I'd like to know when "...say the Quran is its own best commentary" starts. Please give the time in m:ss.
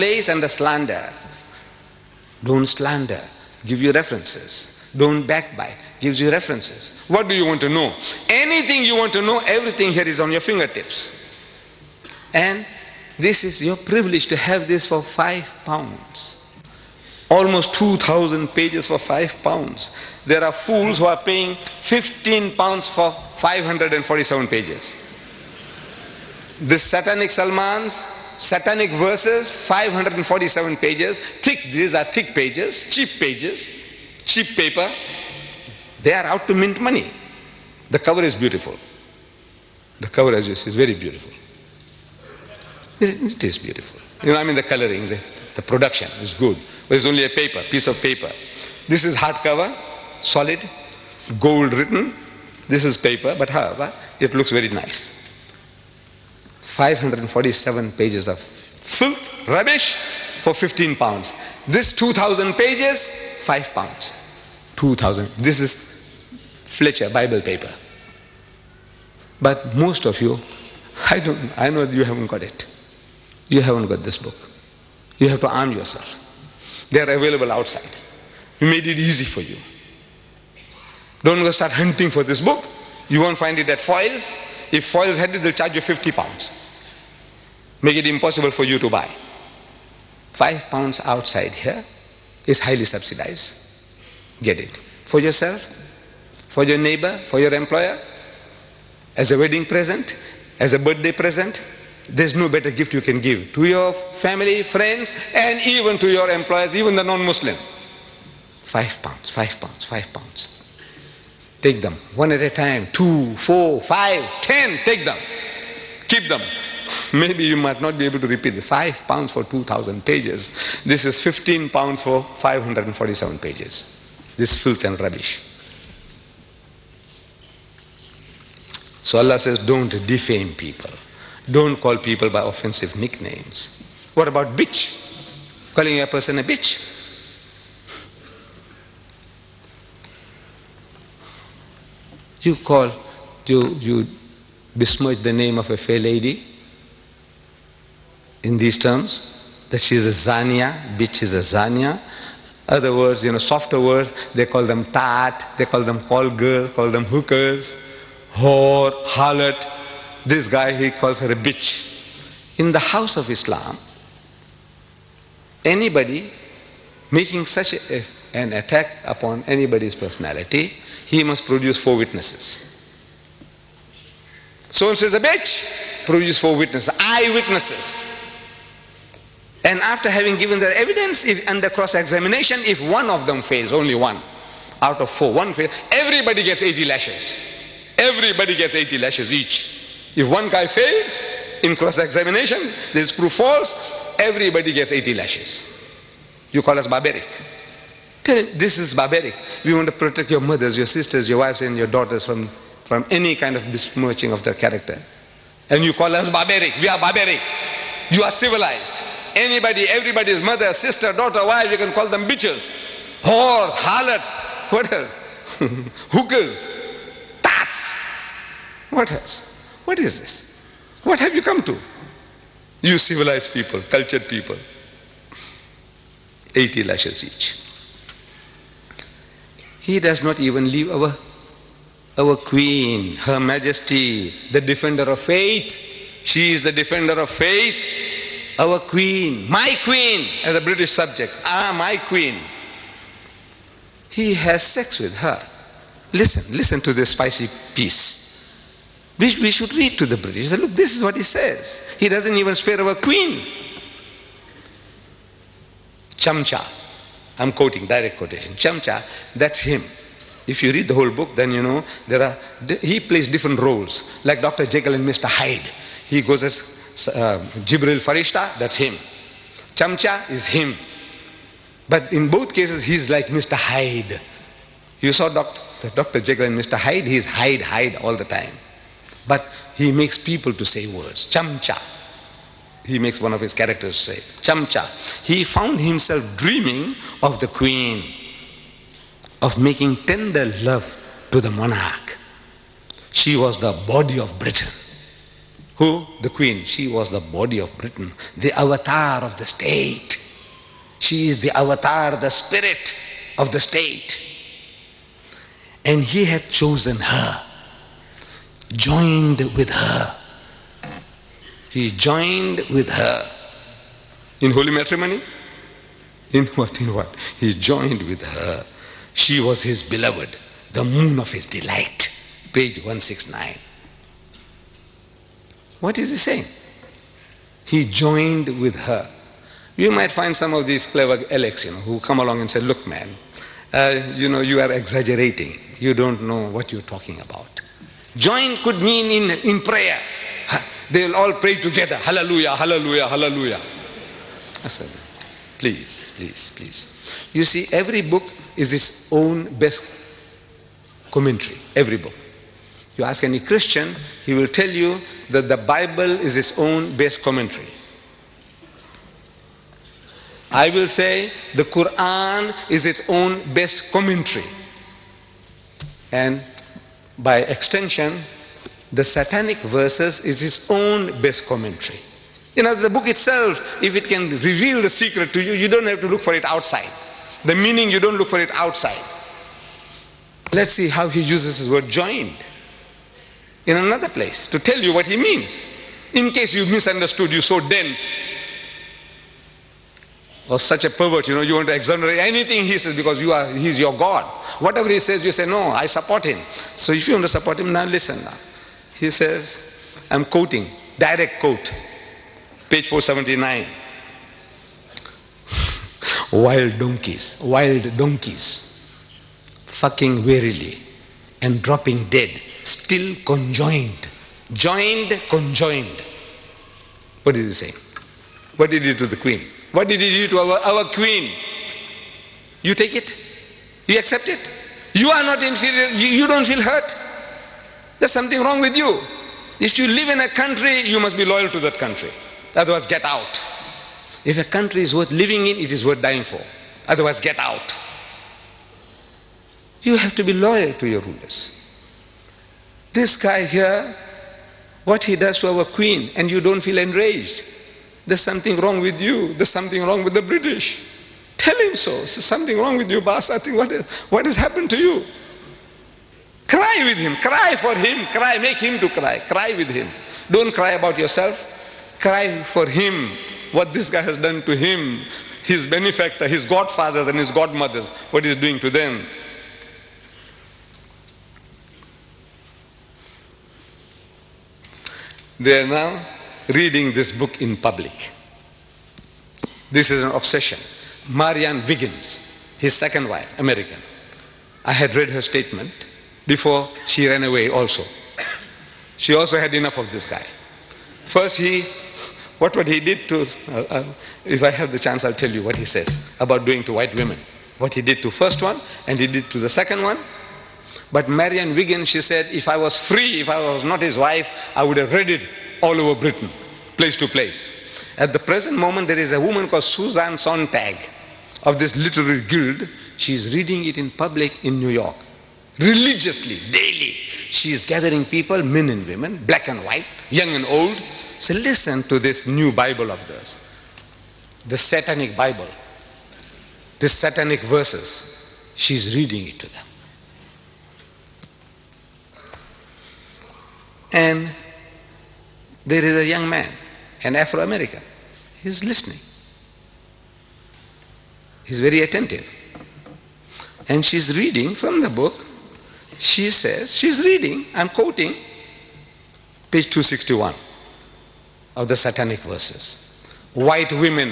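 6:00.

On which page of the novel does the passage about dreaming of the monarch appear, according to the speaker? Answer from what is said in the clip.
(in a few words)
169.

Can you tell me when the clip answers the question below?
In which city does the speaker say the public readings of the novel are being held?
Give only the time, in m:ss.
8:34.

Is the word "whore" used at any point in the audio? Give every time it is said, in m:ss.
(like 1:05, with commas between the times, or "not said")
2:38, 3:33.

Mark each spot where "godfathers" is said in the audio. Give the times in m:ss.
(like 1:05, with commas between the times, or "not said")
7:46.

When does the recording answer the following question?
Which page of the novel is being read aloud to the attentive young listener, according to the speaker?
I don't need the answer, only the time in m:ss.
9:09.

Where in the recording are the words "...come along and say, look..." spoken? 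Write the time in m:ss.
5:32.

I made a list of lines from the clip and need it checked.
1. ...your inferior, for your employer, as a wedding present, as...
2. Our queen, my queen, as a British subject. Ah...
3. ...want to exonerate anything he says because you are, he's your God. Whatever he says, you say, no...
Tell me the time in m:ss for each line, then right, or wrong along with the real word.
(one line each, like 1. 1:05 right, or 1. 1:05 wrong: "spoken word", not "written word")
1. 1:36 wrong: "neighbor", not "inferior"
2. 3:58 right
3. 6:31 right.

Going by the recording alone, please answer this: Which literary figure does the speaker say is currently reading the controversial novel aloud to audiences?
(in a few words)
Suzanne Sontag.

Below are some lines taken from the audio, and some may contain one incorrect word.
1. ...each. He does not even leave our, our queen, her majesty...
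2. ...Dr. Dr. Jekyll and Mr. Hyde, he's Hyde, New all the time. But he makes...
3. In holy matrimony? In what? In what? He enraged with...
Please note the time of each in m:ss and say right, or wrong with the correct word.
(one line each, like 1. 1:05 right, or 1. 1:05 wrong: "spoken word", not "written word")
1. 3:47 right
2. 4:35 wrong: "Hyde", not "New"
3. 5:14 wrong: "joined", not "enraged".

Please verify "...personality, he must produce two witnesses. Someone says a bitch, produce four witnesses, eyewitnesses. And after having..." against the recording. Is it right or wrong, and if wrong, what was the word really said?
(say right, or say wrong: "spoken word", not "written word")
wrong: "four", not "two".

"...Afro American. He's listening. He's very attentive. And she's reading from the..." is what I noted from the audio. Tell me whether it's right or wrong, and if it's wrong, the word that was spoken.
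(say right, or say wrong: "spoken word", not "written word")
right.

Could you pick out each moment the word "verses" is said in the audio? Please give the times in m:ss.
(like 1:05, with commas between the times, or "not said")
0:28, 6:09, 8:47, 9:12.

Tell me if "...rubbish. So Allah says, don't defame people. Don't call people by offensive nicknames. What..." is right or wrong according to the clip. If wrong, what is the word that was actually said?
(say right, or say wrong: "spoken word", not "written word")
right.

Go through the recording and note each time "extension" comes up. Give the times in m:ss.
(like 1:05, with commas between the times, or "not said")
6:07.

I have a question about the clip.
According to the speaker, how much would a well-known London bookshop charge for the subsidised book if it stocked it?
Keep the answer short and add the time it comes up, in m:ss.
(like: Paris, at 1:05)
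50 pounds, at 1:25.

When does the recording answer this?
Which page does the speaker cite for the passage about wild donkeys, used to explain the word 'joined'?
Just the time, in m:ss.
6:42.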